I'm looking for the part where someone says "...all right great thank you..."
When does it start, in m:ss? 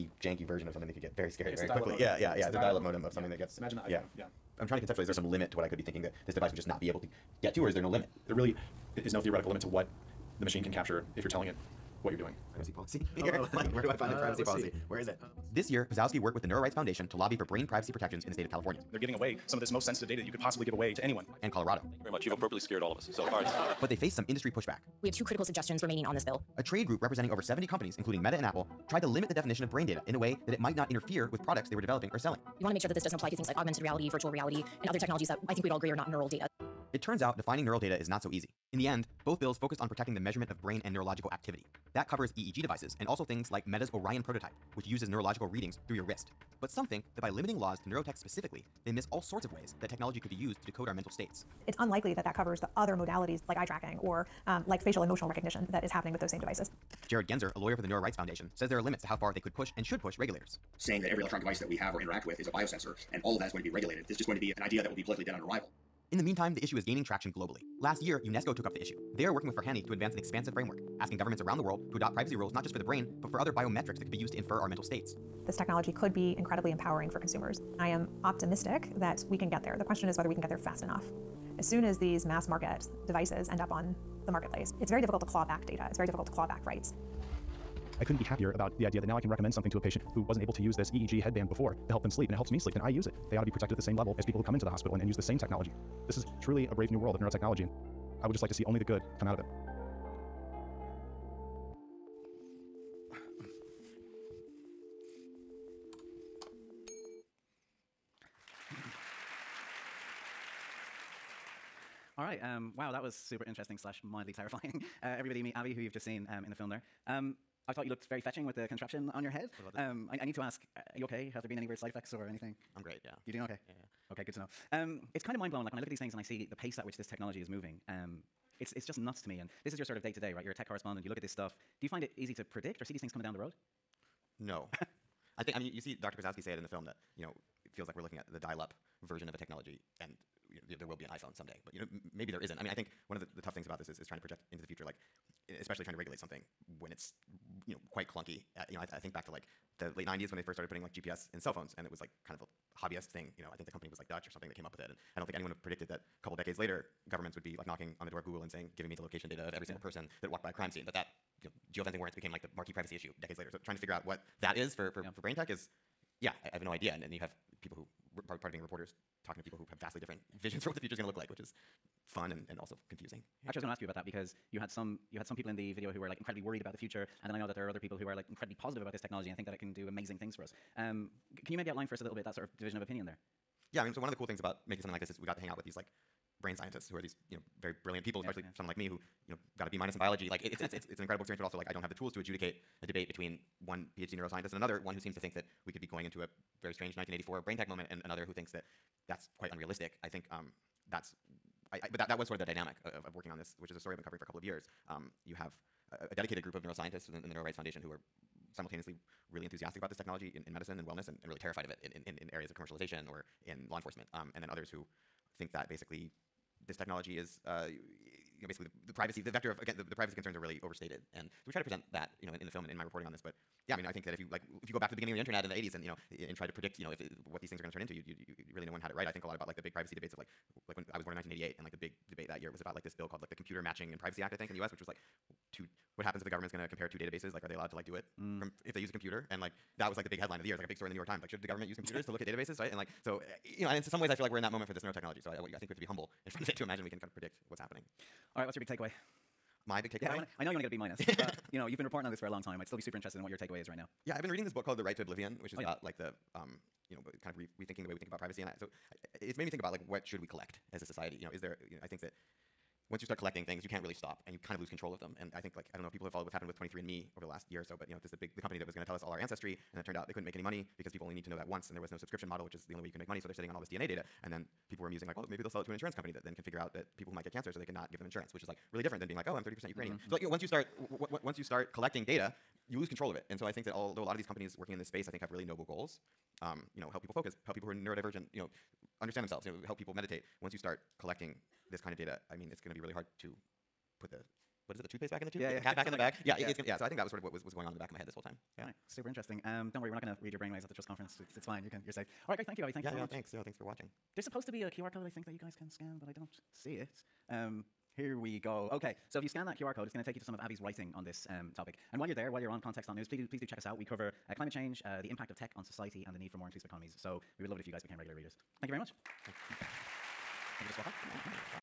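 5:02.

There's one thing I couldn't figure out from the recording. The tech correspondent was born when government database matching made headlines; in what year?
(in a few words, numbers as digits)
1988.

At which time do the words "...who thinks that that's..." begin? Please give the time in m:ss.
3:18.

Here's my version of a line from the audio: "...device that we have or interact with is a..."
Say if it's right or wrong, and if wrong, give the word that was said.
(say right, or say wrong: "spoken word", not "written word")
right.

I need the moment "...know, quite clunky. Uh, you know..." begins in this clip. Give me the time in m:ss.
2:27.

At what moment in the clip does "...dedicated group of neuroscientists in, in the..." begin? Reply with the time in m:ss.
3:26.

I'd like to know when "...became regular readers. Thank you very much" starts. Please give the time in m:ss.
5:17.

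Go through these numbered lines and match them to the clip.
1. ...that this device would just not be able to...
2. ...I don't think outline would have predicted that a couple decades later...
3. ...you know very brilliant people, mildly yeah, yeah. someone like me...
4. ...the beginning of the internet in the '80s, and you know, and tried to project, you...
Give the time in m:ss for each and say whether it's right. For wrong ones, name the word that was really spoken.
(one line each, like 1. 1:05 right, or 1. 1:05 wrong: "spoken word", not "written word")
1. 0:06 right
2. 2:35 wrong: "anyone", not "outline"
3. 3:07 wrong: "especially", not "mildly"
4. 3:44 wrong: "predict", not "project".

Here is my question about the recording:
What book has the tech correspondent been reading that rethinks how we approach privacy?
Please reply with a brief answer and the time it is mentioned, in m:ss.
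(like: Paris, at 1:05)
The Right to Oblivion, at 4:14.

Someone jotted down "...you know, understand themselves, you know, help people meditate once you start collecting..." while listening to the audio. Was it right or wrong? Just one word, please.
right.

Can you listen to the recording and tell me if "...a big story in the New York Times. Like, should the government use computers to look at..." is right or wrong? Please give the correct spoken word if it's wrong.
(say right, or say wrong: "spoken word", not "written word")
right.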